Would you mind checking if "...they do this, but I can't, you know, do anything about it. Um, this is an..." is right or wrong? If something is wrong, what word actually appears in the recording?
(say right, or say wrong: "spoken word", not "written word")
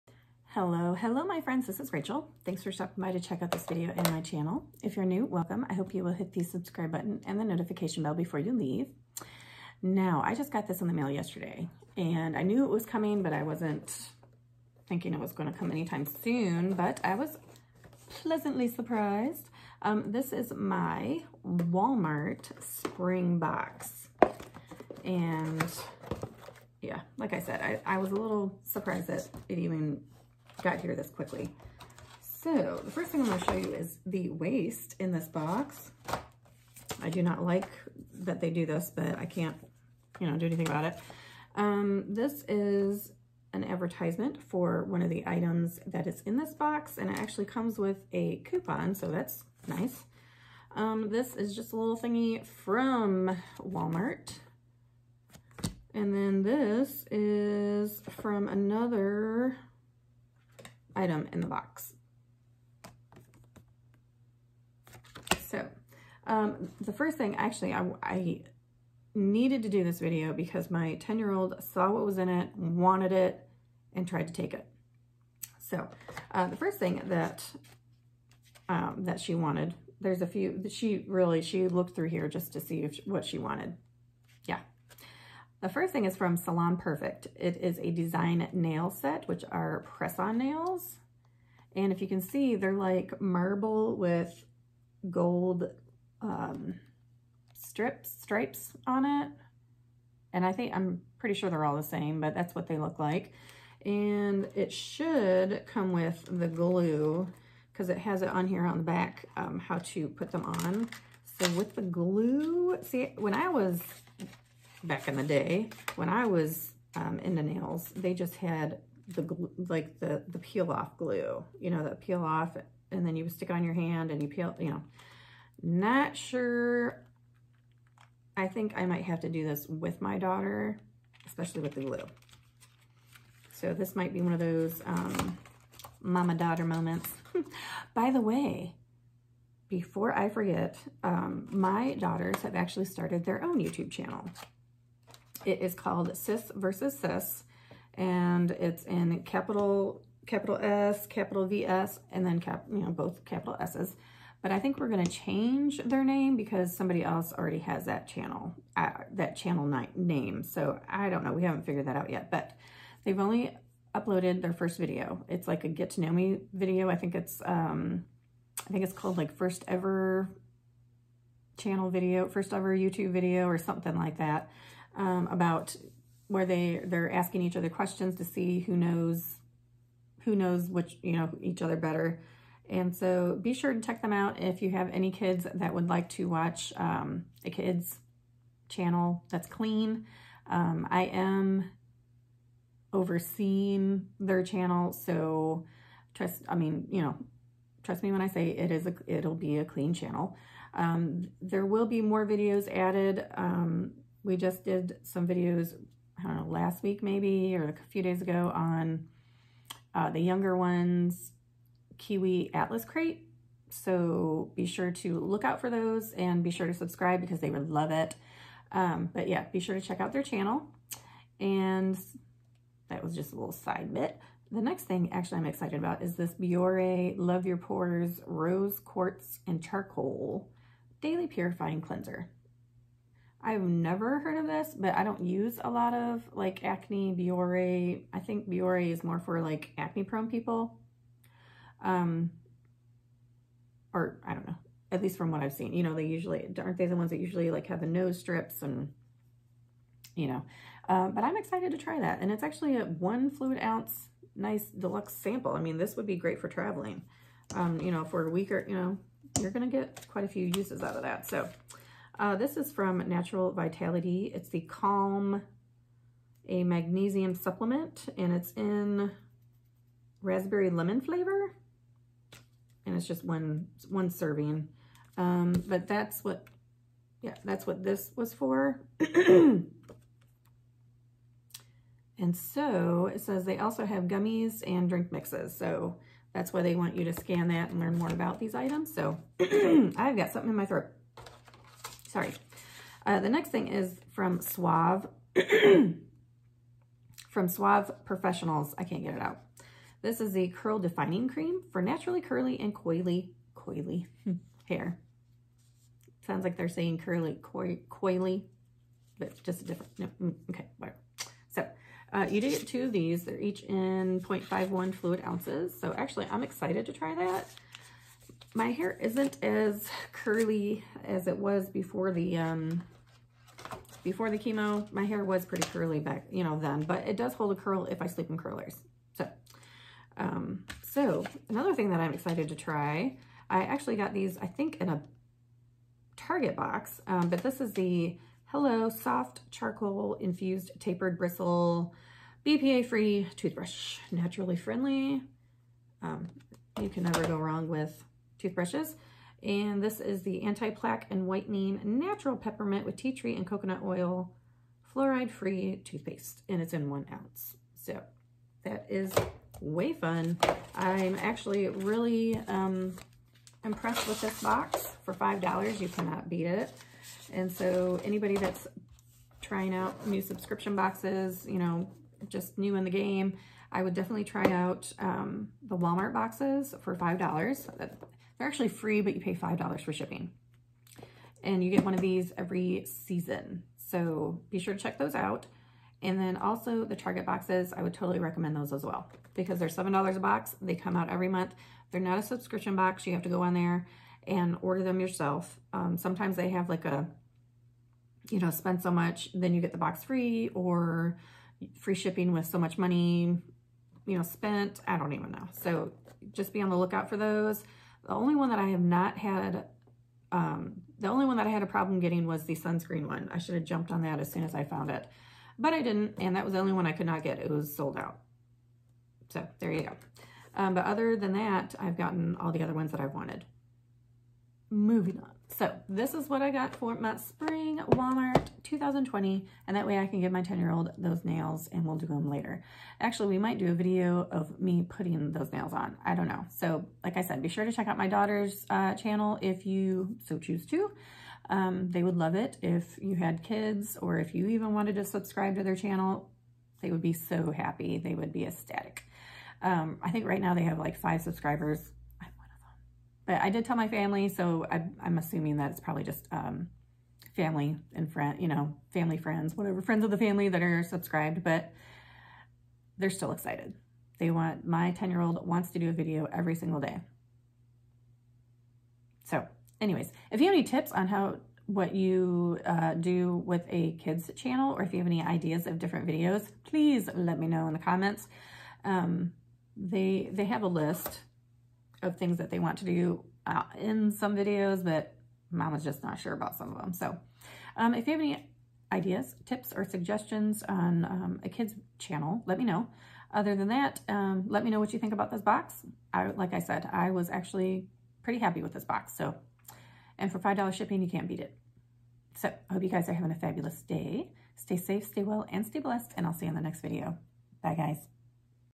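right.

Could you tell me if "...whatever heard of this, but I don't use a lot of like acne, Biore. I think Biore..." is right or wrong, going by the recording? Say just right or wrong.
wrong.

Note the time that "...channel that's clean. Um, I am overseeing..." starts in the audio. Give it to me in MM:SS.
03:08.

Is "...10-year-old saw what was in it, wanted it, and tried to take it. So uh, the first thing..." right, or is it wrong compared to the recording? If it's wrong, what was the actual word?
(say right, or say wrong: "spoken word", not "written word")
right.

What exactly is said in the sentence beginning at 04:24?
It's the Calm, a magnesium supplement, and it's in raspberry lemon flavor.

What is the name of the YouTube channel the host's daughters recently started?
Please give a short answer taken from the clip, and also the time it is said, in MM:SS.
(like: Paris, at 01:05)
Sis versus Sis, at 02:26.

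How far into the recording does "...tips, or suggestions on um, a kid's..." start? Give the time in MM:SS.
08:09.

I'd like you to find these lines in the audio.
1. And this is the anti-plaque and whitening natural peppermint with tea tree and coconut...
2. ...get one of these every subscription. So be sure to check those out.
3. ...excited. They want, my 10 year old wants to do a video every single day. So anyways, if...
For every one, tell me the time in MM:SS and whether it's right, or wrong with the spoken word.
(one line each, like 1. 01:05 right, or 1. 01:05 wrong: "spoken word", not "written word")
1. 05:49 right
2. 06:21 wrong: "season", not "subscription"
3. 07:43 right.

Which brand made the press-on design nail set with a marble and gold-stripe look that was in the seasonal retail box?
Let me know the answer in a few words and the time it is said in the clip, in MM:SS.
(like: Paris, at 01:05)
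Salon Perfect, at 01:26.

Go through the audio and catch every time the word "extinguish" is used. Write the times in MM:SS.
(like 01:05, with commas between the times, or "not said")
not said.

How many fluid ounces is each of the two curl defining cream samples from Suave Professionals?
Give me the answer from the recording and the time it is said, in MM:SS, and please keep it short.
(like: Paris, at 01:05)
0.51, at 05:14.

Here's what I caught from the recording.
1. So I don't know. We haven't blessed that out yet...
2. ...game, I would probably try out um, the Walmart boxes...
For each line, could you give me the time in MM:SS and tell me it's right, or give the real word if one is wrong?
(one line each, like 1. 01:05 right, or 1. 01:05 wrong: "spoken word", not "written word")
1. 02:40 wrong: "figured", not "blessed"
2. 06:12 wrong: "definitely", not "probably".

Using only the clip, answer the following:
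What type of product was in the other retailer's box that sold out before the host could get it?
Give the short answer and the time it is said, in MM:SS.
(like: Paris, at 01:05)
Sunscreen, at 06:52.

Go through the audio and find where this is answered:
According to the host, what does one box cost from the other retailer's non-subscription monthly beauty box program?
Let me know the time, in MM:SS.
06:29.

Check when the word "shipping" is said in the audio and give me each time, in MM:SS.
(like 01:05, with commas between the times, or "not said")
06:19, 06:41, 08:20.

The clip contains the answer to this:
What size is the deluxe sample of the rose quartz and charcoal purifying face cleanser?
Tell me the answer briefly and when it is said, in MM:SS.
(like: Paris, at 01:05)
1 fluid ounce, at 04:12.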